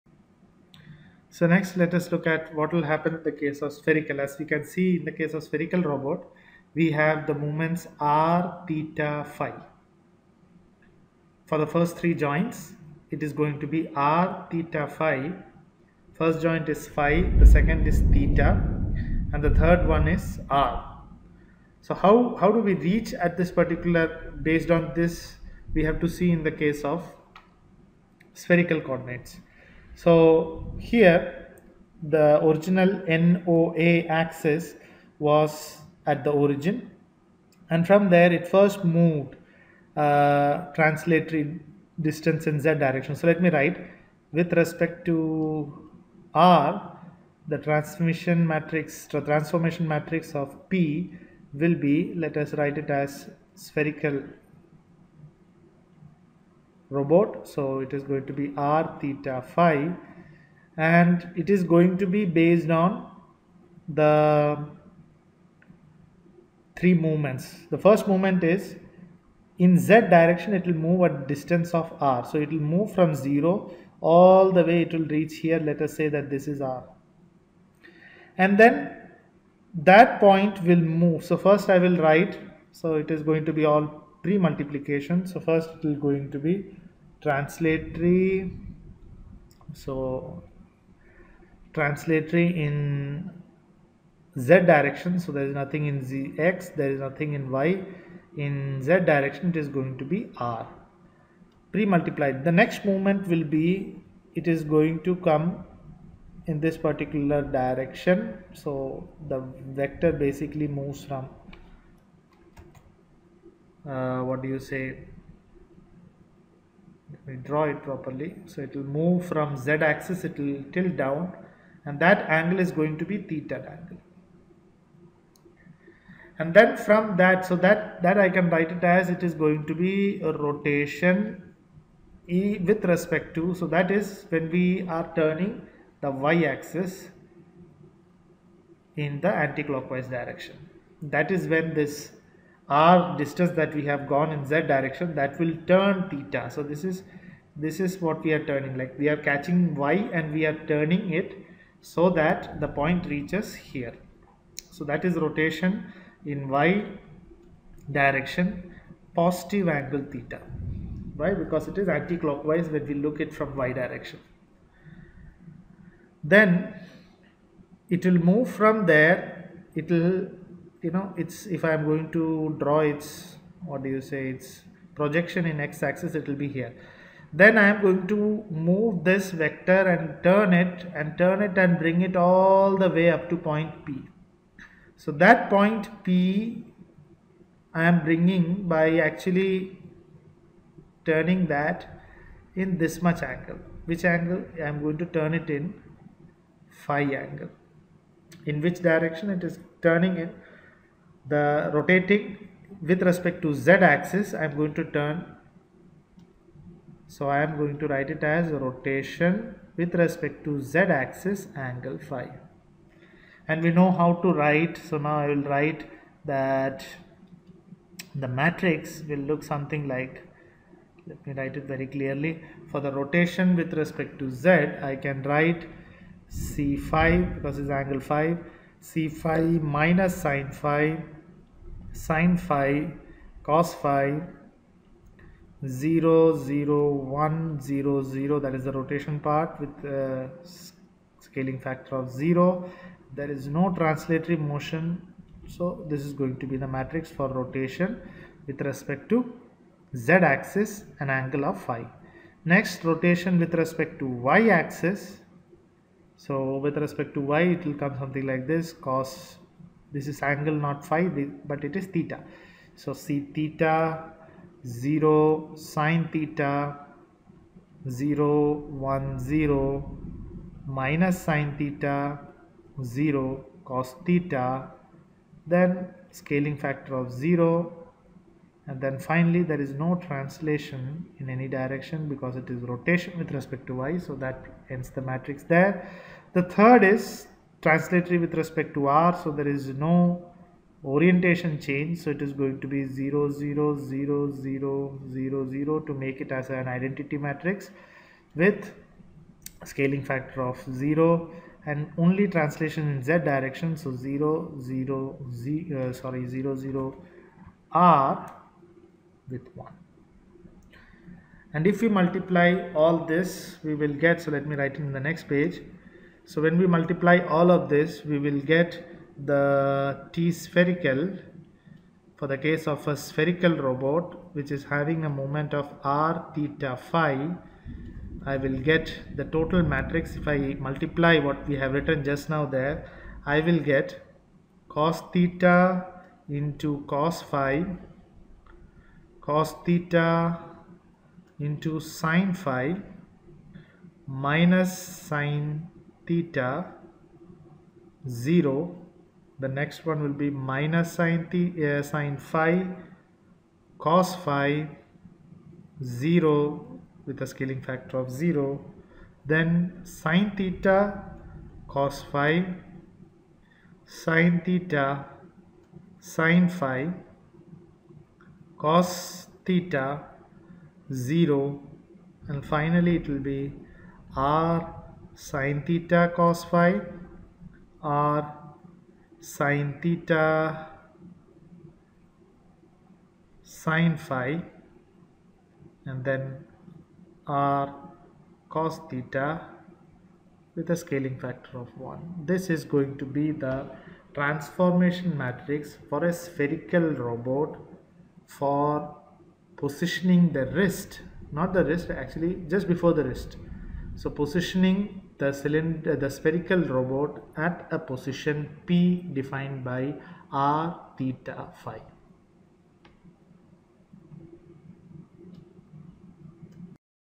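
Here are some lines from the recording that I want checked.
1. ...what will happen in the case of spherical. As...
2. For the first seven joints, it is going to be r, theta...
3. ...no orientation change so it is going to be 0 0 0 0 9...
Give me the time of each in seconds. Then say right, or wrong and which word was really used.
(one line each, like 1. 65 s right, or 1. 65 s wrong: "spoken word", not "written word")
1. 2 s right
2. 11 s wrong: "three", not "seven"
3. 289 s wrong: "0", not "9".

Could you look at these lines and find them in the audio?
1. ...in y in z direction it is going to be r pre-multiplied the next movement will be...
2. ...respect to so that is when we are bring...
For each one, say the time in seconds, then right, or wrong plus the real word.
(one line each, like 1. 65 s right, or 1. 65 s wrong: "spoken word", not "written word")
1. 97 s right
2. 132 s wrong: "turning", not "bring".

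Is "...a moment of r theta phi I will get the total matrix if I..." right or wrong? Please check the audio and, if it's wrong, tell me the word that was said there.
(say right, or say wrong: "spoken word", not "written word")
right.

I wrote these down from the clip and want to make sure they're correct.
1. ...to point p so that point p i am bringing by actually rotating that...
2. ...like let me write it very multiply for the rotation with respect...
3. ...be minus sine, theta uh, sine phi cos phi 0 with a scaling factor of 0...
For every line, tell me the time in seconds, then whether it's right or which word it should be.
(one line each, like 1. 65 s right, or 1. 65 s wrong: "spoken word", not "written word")
1. 183 s wrong: "turning", not "rotating"
2. 219 s wrong: "clearly", not "multiply"
3. 350 s right.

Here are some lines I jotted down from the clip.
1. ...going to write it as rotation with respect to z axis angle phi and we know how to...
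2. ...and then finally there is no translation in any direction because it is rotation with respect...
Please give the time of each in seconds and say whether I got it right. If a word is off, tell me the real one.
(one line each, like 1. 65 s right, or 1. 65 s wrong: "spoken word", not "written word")
1. 207 s right
2. 278 s right.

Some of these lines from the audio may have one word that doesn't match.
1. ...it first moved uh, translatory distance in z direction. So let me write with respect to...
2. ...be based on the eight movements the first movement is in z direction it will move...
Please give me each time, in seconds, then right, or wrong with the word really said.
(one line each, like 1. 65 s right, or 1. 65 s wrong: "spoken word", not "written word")
1. 38 s right
2. 62 s wrong: "three", not "eight".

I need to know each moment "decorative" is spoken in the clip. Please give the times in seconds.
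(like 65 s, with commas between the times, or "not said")
not said.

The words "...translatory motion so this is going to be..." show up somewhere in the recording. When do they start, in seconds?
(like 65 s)
243 s.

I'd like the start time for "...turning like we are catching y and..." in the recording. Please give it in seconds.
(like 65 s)
148 s.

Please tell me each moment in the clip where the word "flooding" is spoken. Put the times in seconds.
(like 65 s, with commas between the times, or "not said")
not said.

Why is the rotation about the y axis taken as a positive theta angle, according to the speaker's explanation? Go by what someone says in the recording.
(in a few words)
it is anti-clockwise.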